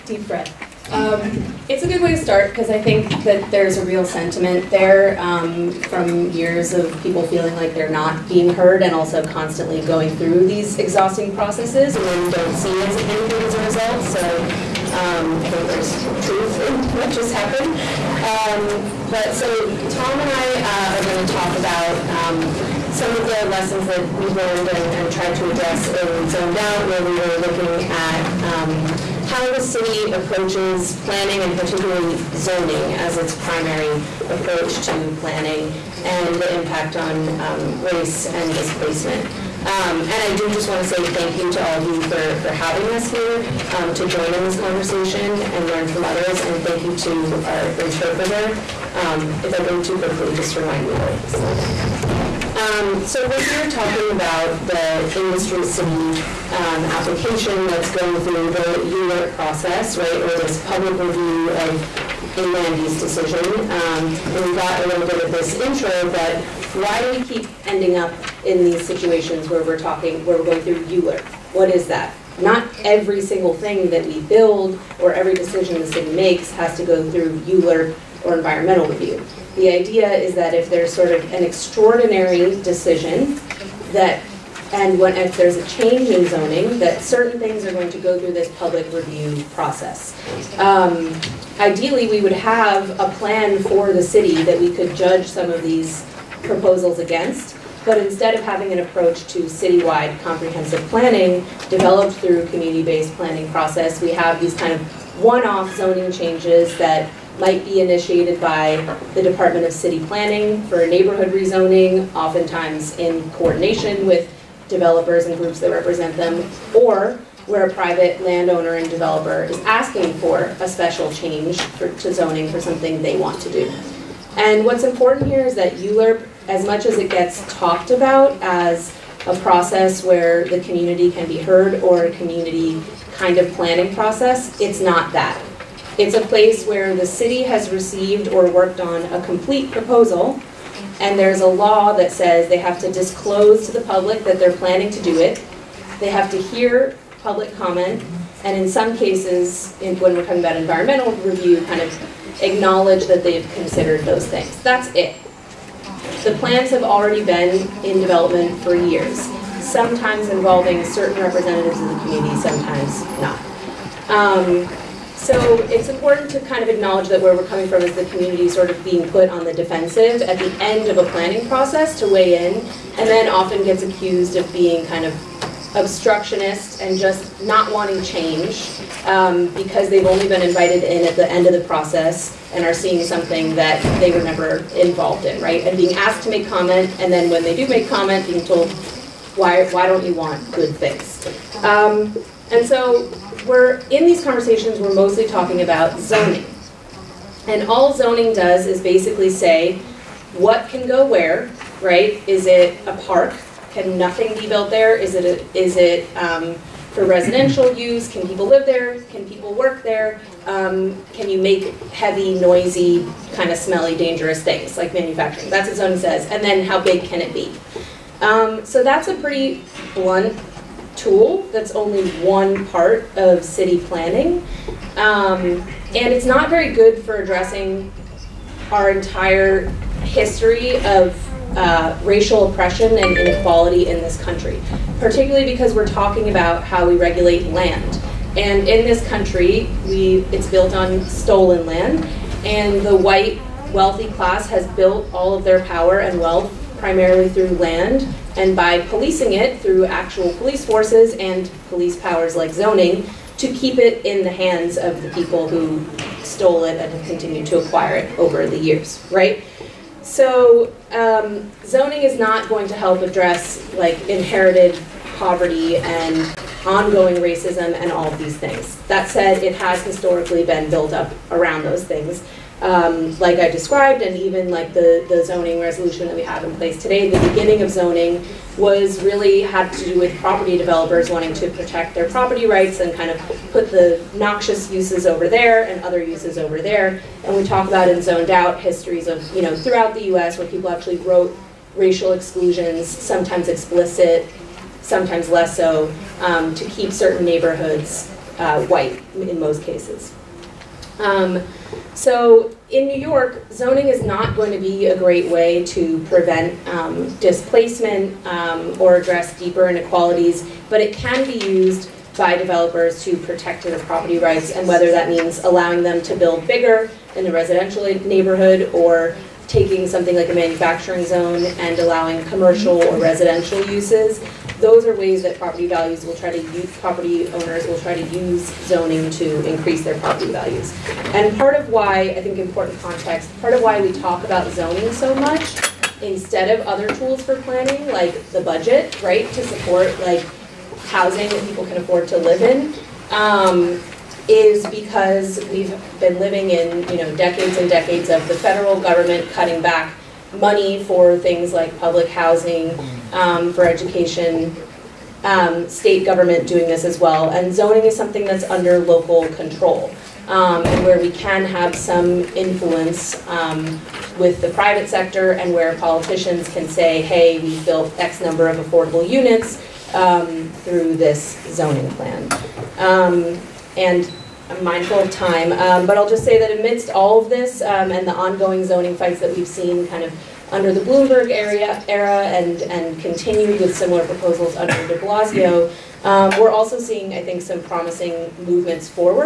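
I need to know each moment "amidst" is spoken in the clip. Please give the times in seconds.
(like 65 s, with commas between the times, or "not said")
376 s.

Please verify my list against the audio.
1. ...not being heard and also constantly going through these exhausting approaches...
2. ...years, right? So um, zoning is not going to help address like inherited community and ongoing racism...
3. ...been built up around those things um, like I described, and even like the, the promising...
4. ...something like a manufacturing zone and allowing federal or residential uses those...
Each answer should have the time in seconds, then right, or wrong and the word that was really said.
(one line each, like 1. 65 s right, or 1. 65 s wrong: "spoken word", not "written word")
1. 7 s wrong: "processes", not "approaches"
2. 258 s wrong: "poverty", not "community"
3. 270 s wrong: "zoning", not "promising"
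4. 319 s wrong: "commercial", not "federal".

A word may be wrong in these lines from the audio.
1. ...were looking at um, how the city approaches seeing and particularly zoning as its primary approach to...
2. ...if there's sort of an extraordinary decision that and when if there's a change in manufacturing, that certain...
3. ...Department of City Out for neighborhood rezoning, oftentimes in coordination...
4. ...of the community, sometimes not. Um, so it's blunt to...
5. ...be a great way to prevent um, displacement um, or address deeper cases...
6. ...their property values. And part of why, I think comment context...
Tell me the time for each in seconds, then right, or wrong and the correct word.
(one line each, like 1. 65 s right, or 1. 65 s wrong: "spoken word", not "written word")
1. 27 s wrong: "planning", not "seeing"
2. 80 s wrong: "zoning", not "manufacturing"
3. 109 s wrong: "Planning", not "Out"
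4. 161 s wrong: "important", not "blunt"
5. 304 s wrong: "inequalities", not "cases"
6. 329 s wrong: "important", not "comment".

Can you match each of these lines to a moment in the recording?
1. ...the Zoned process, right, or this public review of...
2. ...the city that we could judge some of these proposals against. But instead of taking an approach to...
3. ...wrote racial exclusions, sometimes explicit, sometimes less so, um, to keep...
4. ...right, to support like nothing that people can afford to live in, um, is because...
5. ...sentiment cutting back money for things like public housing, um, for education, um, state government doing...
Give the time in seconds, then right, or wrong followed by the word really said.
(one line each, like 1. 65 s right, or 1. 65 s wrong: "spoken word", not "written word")
1. 58 s wrong: "ULURP", not "Zoned"
2. 93 s wrong: "having", not "taking"
3. 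290 s right
4. 339 s wrong: "housing", not "nothing"
5. 348 s wrong: "government", not "sentiment".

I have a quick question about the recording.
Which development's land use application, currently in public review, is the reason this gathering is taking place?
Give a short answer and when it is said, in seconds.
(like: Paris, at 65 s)
Industry City, at 55 s.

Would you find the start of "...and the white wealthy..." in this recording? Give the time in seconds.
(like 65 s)
242 s.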